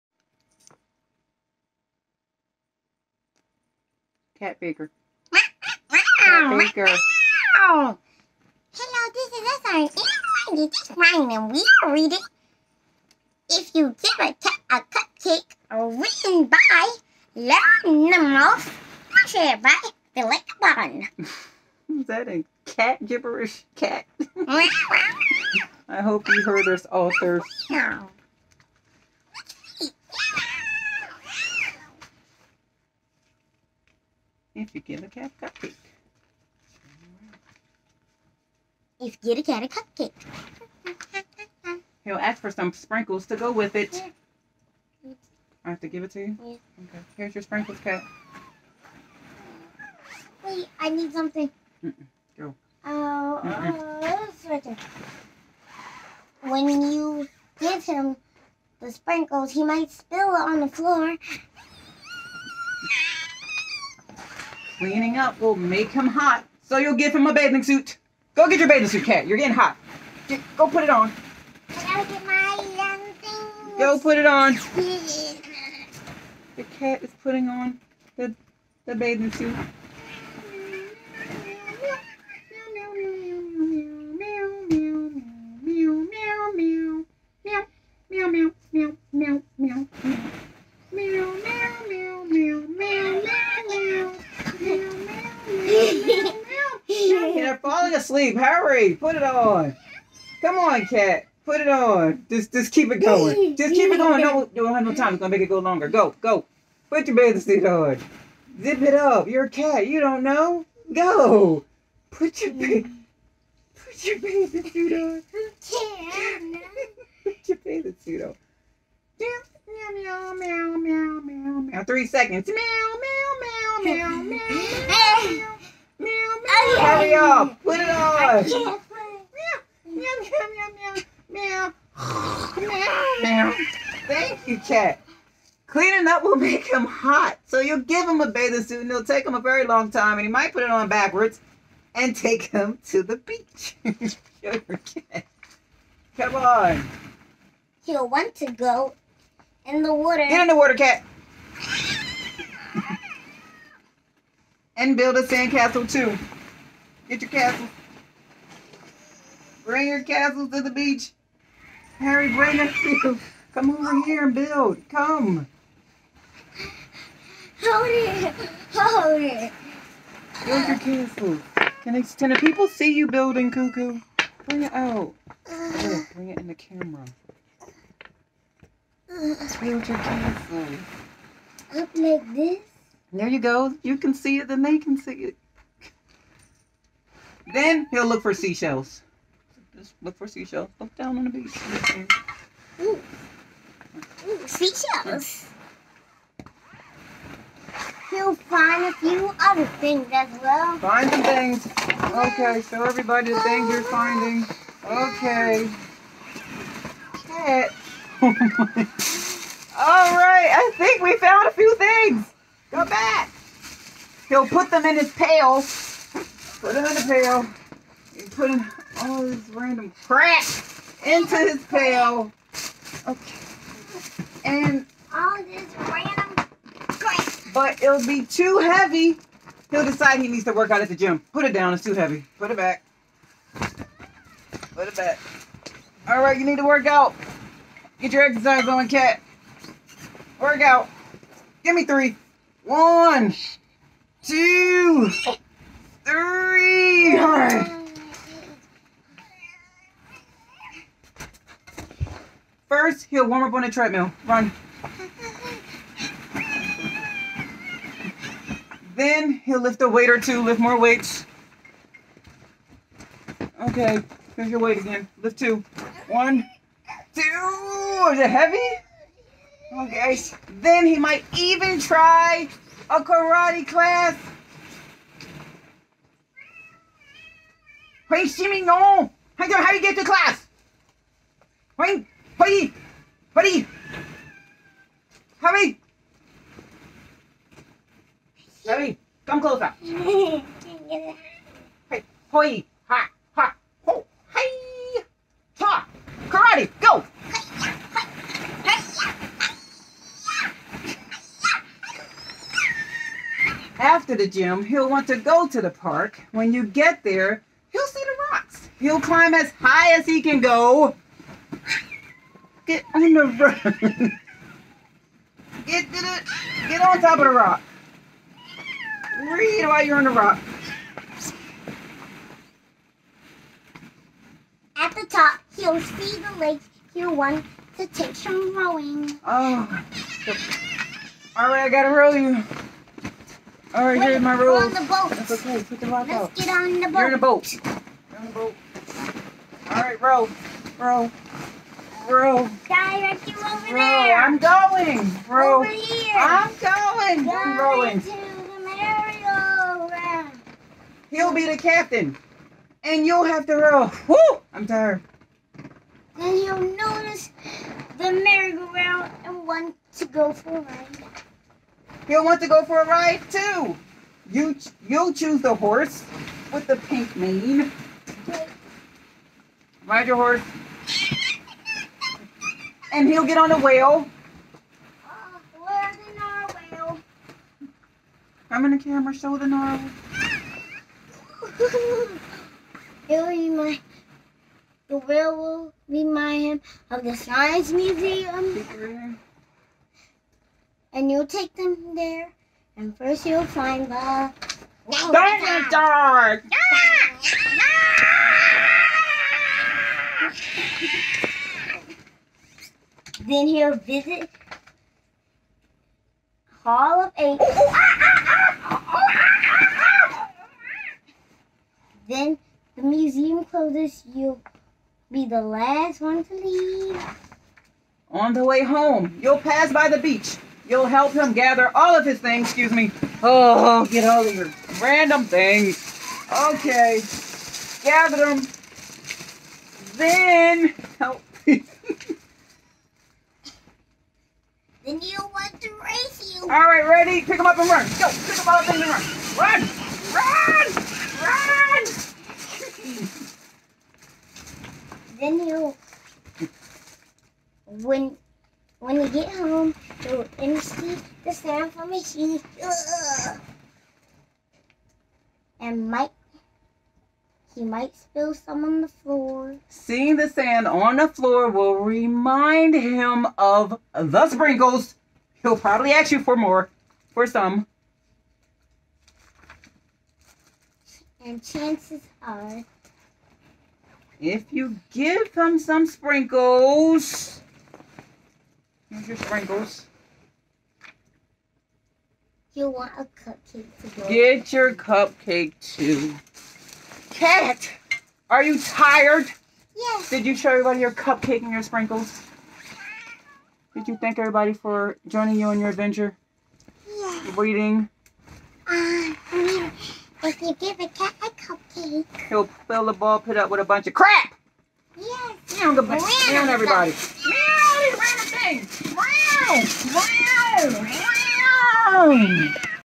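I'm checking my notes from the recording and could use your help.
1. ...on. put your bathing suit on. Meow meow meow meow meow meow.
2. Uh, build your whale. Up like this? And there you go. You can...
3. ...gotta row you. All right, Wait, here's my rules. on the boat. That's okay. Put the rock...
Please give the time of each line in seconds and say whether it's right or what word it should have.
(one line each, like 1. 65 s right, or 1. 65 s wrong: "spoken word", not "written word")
1. 114 s right
2. 177 s wrong: "castle", not "whale"
3. 331 s right.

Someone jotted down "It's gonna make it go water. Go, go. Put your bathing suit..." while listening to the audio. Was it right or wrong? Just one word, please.
wrong.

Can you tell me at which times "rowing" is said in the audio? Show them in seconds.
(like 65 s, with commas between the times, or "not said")
328 s, 347 s.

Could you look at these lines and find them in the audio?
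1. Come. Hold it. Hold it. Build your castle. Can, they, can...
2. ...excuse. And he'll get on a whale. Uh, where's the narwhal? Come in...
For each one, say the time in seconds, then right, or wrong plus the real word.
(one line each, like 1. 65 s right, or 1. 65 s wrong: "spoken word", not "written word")
1. 164 s right
2. 370 s wrong: "horse", not "excuse".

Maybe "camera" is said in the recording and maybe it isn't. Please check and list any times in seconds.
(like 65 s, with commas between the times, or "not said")
176 s, 378 s.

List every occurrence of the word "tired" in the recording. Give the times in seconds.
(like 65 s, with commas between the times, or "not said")
354 s, 488 s.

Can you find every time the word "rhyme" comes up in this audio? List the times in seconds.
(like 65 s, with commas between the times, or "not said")
10 s.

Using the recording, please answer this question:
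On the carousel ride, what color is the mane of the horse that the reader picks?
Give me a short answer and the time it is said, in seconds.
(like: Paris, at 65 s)
pink, at 366 s.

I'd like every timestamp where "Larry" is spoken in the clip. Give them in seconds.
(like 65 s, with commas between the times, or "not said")
288 s.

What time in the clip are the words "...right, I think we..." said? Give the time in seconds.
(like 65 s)
210 s.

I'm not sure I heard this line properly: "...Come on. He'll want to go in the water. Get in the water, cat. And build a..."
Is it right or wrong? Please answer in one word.
right.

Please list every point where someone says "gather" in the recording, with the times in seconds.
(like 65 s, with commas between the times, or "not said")
421 s, 427 s.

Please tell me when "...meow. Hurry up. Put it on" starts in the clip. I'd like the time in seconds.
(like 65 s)
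126 s.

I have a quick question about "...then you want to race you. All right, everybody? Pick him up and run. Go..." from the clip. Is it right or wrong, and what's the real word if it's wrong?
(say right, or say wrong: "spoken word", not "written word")
wrong: "ready", not "everybody".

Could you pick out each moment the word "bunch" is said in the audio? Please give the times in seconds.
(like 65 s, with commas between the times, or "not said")
503 s.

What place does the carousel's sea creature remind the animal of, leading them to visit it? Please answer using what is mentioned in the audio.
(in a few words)
the science museum.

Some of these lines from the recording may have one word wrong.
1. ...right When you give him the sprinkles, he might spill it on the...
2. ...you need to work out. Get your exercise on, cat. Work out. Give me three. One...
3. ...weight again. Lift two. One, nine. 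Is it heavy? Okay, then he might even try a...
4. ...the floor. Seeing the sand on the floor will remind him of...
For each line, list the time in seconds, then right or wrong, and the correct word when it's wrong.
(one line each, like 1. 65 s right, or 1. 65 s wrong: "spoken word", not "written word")
1. 54 s right
2. 236 s right
3. 264 s wrong: "two", not "nine"
4. 458 s right.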